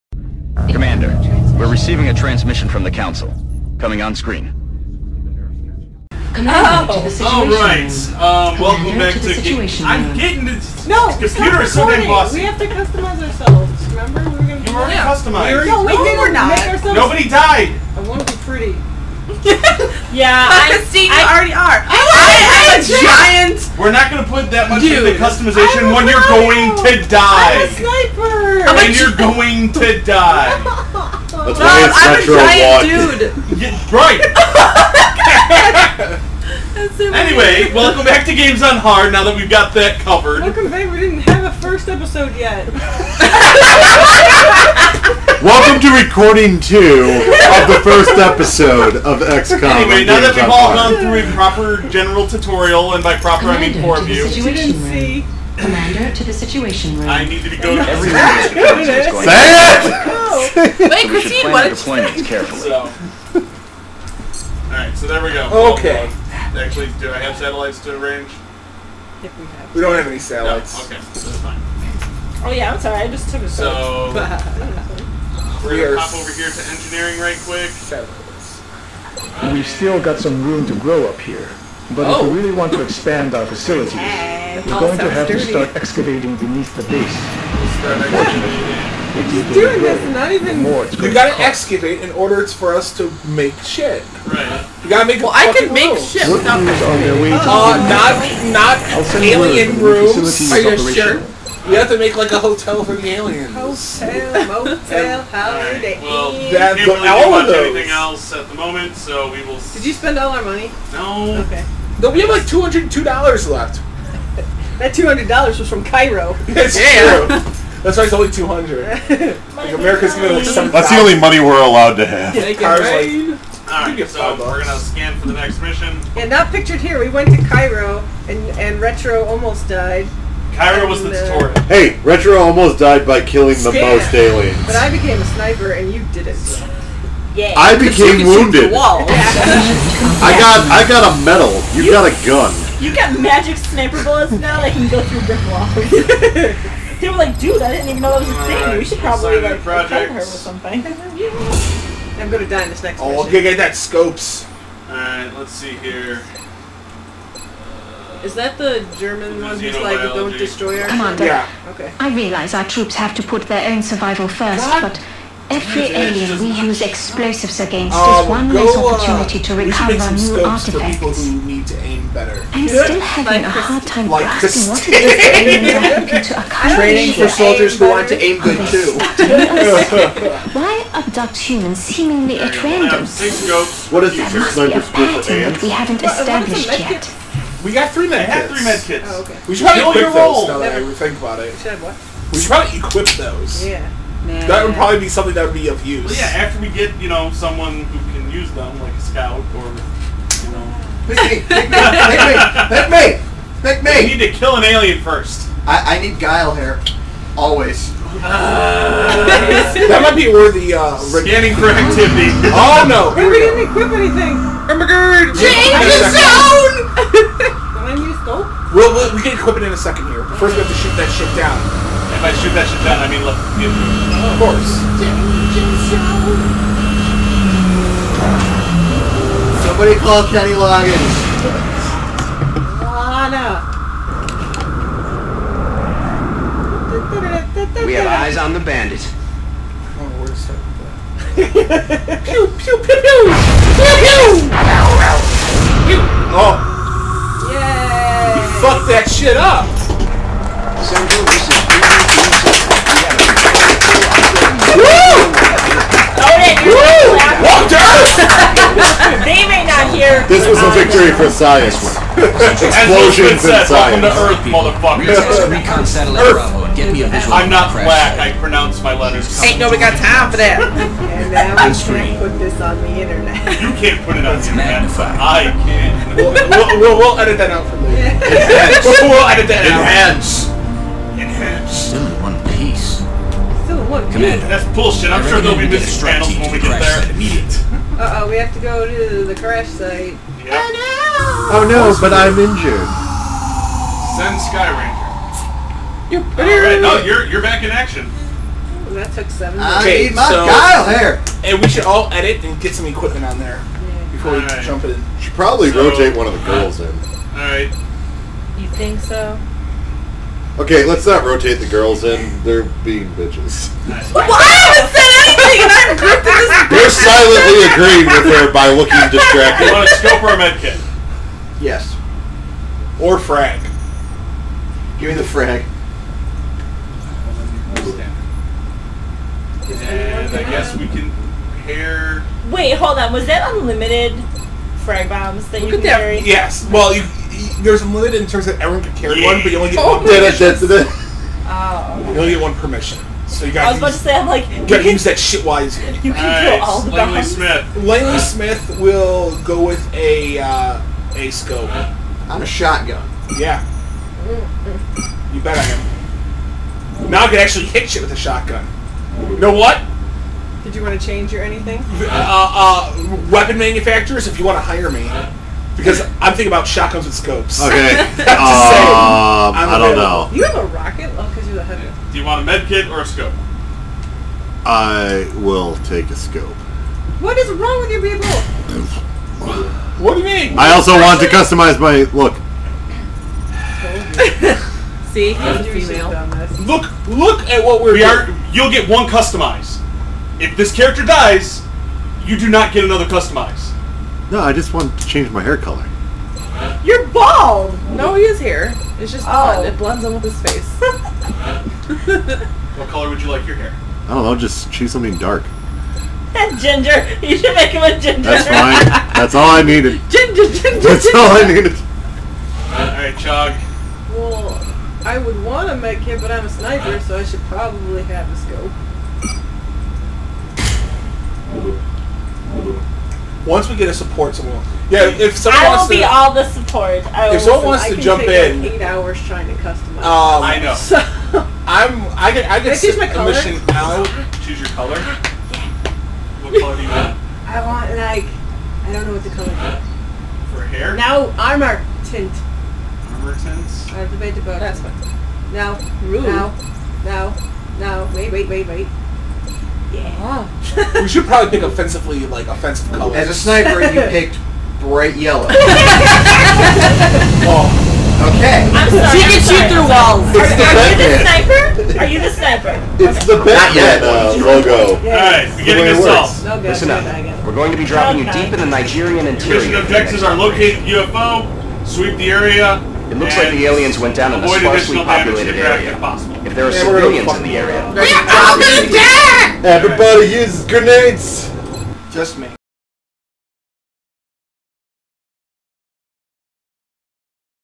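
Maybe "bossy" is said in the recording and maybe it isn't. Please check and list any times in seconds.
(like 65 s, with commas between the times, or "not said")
12 s.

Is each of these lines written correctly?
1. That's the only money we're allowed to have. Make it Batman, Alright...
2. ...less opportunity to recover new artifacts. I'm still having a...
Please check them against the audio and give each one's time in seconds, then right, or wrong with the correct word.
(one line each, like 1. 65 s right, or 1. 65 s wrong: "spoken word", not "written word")
1. 120 s wrong: "Like", not "Batman"
2. 168 s right.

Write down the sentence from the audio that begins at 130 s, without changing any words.
Cairo and, was the uh, tutorial.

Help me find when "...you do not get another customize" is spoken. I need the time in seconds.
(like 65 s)
392 s.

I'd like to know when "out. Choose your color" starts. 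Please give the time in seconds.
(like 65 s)
433 s.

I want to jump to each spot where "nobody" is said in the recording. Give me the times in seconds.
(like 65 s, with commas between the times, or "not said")
16 s, 269 s.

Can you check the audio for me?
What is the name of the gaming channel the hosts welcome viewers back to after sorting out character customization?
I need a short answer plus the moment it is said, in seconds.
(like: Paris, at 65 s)
Games on Hard, at 38 s.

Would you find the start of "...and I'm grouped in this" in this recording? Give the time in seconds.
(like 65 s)
315 s.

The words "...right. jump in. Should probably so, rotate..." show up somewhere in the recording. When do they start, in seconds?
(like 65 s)
304 s.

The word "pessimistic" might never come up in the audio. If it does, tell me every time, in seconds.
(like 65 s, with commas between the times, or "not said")
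not said.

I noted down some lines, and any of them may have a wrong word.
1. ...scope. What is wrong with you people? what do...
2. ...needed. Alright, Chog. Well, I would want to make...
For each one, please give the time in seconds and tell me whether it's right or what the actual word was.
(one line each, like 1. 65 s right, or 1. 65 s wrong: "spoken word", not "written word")
1. 376 s right
2. 411 s right.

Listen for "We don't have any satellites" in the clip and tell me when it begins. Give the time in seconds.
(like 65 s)
69 s.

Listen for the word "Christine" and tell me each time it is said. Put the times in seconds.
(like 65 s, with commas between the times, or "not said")
20 s, 61 s.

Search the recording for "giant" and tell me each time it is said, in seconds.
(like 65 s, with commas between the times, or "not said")
23 s, 32 s.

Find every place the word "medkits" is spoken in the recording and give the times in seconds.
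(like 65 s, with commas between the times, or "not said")
188 s, 320 s.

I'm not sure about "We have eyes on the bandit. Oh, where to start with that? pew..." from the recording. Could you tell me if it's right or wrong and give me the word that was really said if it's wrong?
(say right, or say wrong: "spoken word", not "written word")
right.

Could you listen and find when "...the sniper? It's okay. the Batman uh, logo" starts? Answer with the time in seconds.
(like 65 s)
462 s.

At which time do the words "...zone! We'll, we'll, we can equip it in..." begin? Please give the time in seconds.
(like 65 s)
217 s.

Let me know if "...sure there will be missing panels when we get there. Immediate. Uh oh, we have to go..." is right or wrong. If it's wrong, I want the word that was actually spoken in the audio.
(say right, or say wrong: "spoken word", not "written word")
right.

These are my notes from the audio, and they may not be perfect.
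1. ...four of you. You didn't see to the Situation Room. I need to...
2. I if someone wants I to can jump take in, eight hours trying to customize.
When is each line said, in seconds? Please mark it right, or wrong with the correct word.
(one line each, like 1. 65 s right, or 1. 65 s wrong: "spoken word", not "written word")
1. 53 s right
2. 427 s right.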